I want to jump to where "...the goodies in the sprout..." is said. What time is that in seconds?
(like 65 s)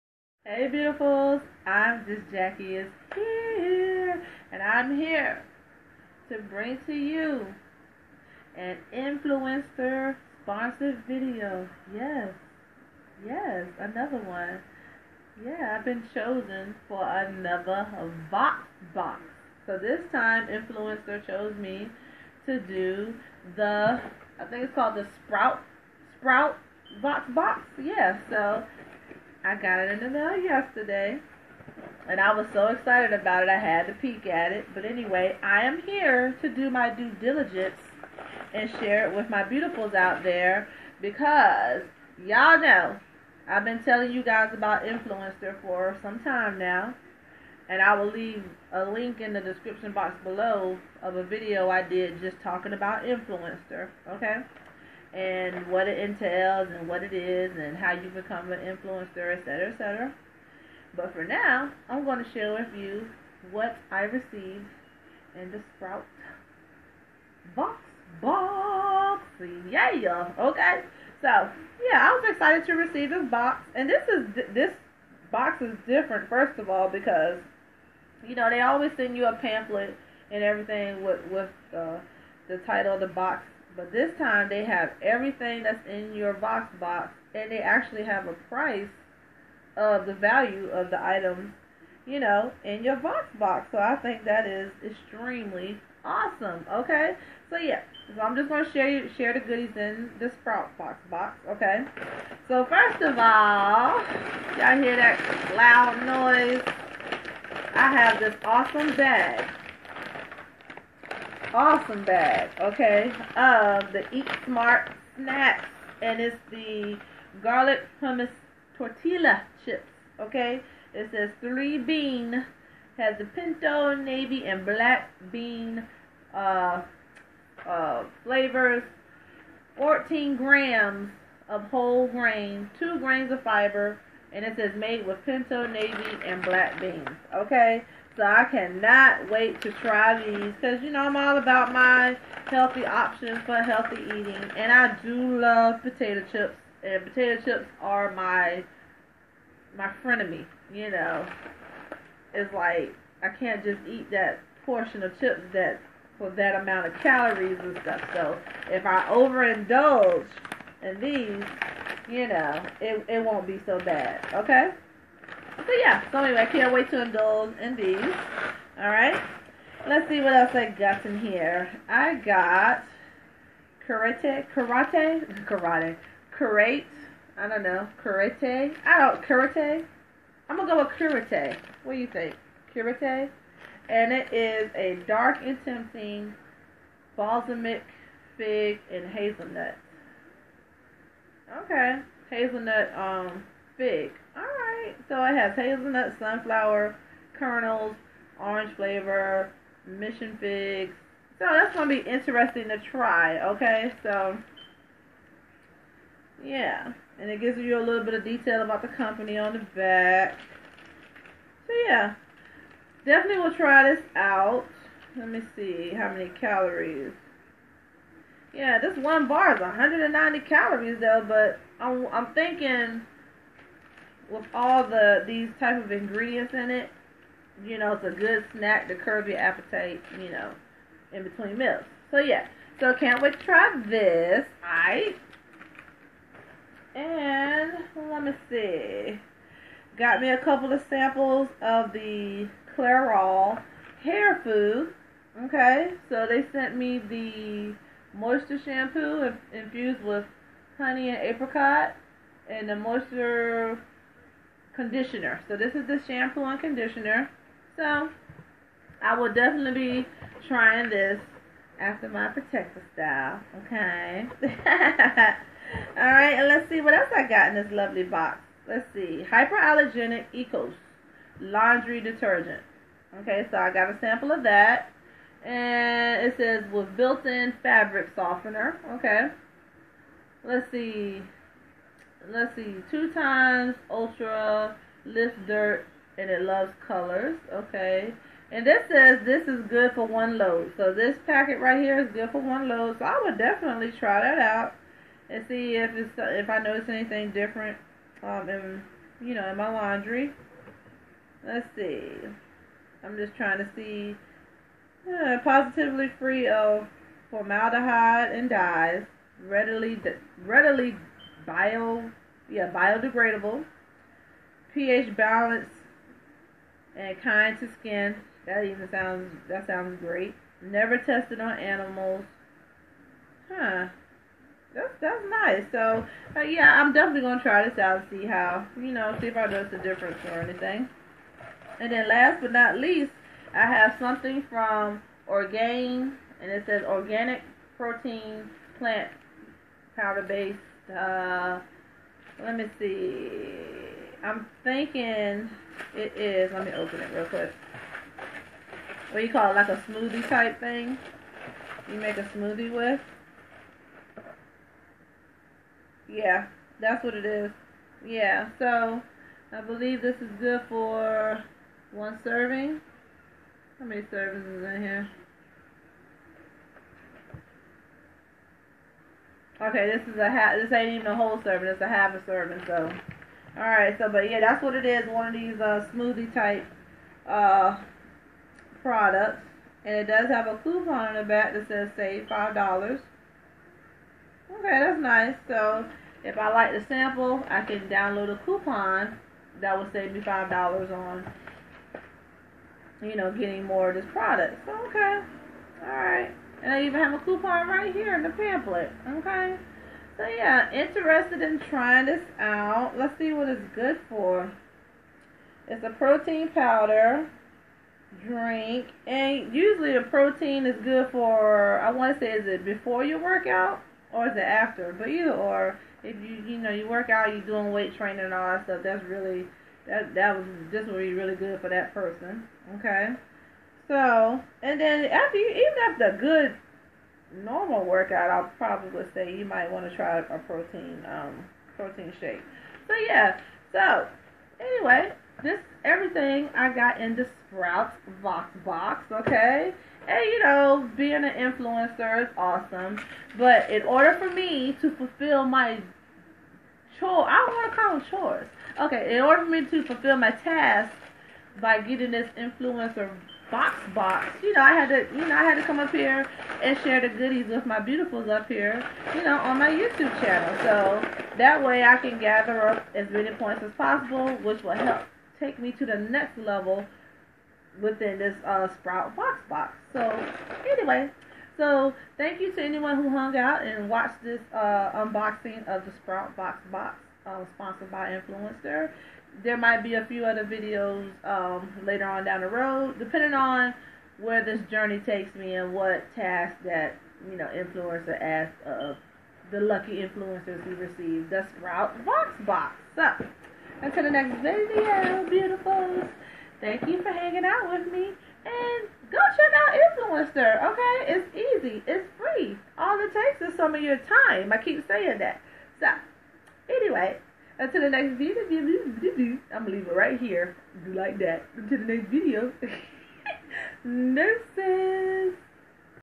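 99 s.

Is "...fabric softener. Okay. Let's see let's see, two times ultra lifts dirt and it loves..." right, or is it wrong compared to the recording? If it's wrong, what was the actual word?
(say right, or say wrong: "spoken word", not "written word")
right.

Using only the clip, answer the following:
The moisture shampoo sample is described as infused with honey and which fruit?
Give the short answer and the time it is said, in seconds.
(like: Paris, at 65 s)
Apricot, at 251 s.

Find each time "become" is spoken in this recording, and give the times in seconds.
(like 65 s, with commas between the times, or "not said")
58 s.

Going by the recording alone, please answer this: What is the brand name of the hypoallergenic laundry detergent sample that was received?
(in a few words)
Ecos.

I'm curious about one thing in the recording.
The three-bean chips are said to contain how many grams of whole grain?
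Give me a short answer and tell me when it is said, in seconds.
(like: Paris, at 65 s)
14, at 129 s.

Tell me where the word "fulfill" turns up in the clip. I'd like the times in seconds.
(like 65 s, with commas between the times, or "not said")
444 s, 449 s.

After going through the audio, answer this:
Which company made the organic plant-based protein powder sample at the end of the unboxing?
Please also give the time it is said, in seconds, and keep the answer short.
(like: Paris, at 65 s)
Orgain, at 335 s.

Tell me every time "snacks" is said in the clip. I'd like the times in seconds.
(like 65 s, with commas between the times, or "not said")
115 s, 228 s.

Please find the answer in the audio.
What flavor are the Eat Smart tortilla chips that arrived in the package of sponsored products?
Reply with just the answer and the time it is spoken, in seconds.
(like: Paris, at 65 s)
Garlic hummus, at 117 s.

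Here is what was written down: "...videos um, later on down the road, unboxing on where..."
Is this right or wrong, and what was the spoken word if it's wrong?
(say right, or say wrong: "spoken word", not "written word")
wrong: "depending", not "unboxing".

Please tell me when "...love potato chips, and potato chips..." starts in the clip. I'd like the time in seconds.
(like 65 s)
145 s.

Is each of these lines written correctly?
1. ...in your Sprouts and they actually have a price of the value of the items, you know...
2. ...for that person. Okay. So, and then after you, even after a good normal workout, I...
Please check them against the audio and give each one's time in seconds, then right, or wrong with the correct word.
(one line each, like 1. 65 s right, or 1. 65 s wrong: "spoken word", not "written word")
1. 85 s wrong: "VoxBox", not "Sprouts"
2. 421 s right.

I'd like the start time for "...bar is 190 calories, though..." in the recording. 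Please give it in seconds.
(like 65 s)
219 s.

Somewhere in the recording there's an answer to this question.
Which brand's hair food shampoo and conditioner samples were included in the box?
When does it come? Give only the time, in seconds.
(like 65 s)
242 s.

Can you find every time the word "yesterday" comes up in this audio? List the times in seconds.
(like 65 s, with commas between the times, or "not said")
30 s.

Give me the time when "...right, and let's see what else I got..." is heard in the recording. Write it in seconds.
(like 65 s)
266 s.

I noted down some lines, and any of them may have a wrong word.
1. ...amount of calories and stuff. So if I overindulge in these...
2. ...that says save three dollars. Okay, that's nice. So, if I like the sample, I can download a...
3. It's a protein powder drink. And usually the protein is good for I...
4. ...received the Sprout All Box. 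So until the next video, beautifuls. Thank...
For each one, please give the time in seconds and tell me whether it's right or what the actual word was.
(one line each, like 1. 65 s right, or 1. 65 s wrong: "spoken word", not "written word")
1. 156 s right
2. 381 s wrong: "five", not "three"
3. 405 s right
4. 490 s wrong: "Box", not "All".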